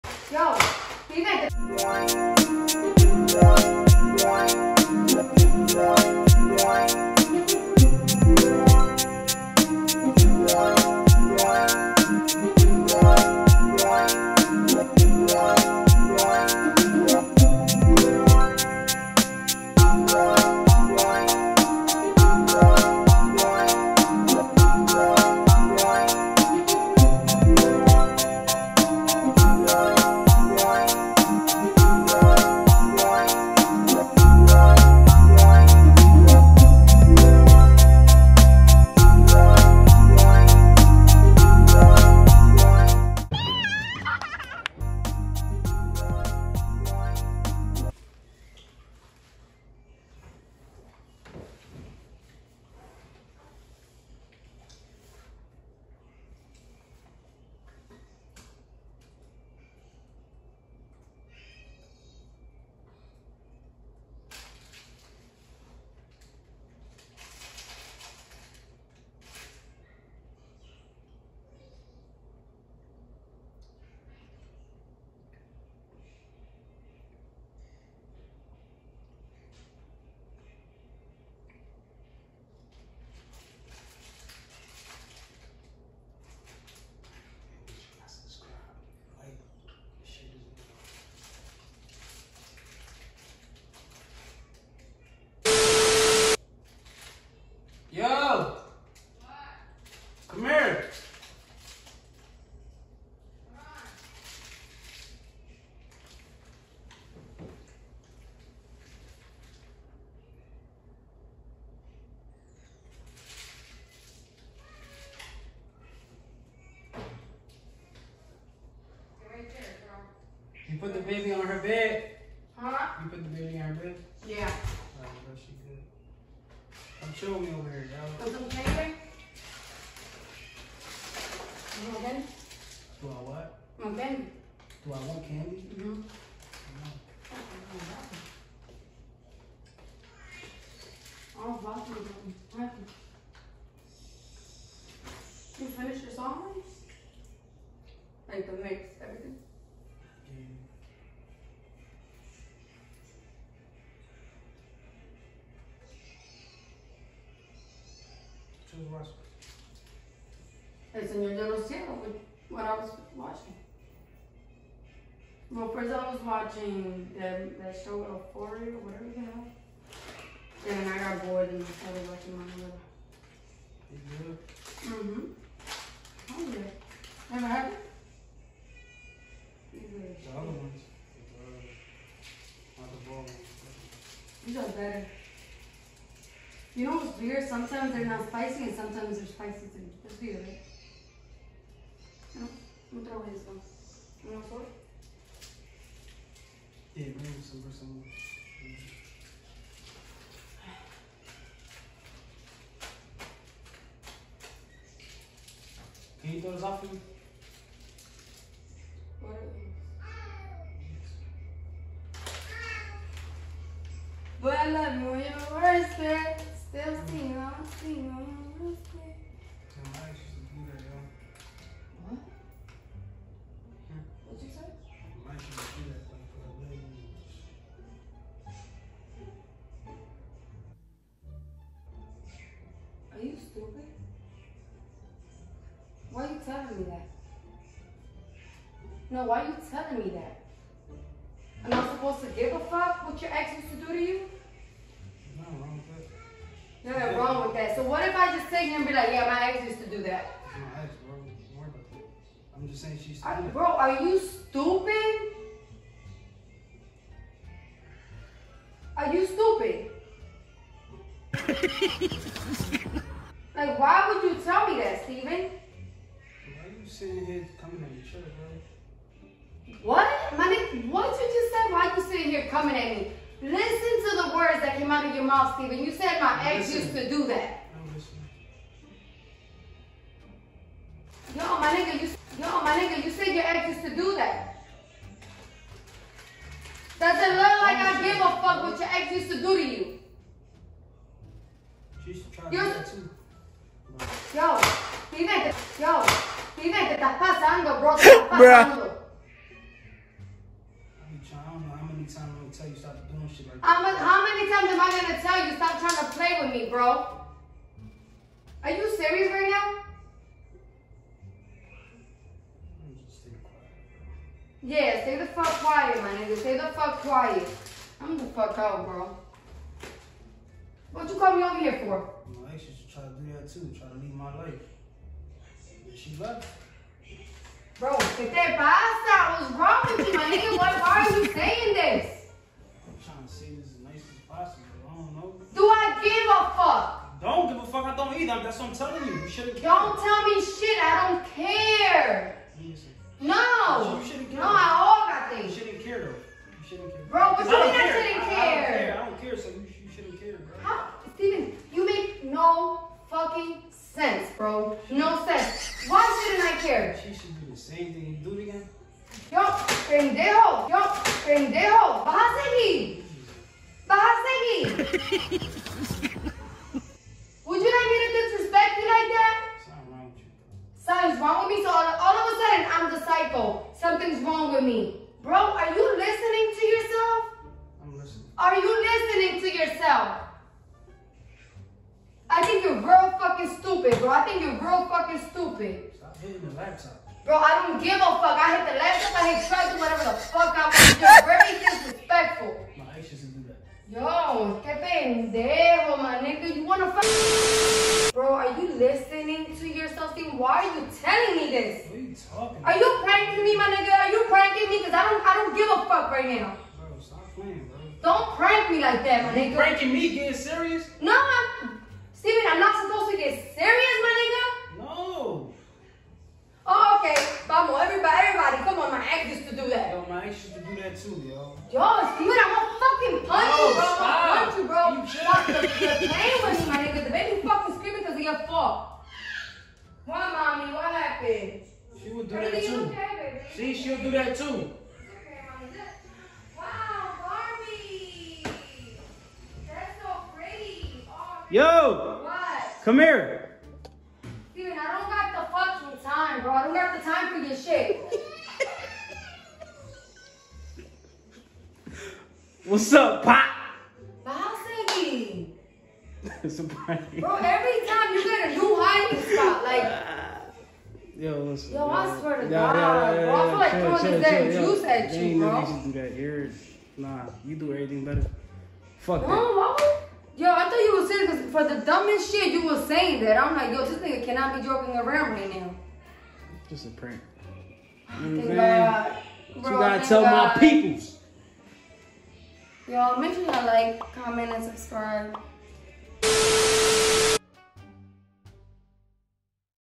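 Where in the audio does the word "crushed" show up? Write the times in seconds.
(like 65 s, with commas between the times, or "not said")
not said.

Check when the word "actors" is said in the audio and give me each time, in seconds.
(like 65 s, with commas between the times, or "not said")
not said.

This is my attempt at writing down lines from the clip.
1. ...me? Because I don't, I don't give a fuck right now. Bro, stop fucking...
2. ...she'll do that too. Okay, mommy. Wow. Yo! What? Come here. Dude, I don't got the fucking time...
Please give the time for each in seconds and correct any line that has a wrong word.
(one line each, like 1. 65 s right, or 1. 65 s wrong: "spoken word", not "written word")
1. 404 s wrong: "playing", not "fucking"
2. 433 s right.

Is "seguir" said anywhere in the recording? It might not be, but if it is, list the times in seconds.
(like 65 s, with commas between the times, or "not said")
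362 s.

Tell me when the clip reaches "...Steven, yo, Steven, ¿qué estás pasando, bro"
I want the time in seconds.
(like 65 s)
295 s.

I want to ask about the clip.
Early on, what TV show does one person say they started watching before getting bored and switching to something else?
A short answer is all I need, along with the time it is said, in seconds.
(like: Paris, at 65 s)
Euphoria, at 167 s.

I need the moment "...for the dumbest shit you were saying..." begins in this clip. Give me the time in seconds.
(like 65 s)
471 s.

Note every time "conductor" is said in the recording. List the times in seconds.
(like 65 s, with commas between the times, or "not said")
not said.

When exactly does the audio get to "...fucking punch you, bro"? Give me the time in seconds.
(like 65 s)
423 s.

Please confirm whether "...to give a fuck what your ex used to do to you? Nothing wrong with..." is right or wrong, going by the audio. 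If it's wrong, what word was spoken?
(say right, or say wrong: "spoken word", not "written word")
right.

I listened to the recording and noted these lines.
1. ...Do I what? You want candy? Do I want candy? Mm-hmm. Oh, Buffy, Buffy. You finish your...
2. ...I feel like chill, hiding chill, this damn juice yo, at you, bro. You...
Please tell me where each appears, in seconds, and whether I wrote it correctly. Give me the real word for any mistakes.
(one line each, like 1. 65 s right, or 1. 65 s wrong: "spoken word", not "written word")
1. 133 s right
2. 463 s wrong: "throwing", not "hiding".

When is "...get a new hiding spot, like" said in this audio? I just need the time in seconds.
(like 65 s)
458 s.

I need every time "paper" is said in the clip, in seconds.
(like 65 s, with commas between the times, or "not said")
128 s.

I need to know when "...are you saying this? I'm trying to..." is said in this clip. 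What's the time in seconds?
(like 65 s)
331 s.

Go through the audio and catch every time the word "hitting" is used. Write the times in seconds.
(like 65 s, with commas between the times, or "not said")
386 s.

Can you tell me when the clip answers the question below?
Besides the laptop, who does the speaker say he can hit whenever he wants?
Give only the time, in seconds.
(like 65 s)
389 s.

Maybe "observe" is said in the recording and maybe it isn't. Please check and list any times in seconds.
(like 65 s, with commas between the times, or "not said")
not said.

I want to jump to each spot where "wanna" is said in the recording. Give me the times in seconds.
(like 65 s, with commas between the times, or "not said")
396 s.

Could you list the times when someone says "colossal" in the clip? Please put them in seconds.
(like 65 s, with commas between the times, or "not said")
not said.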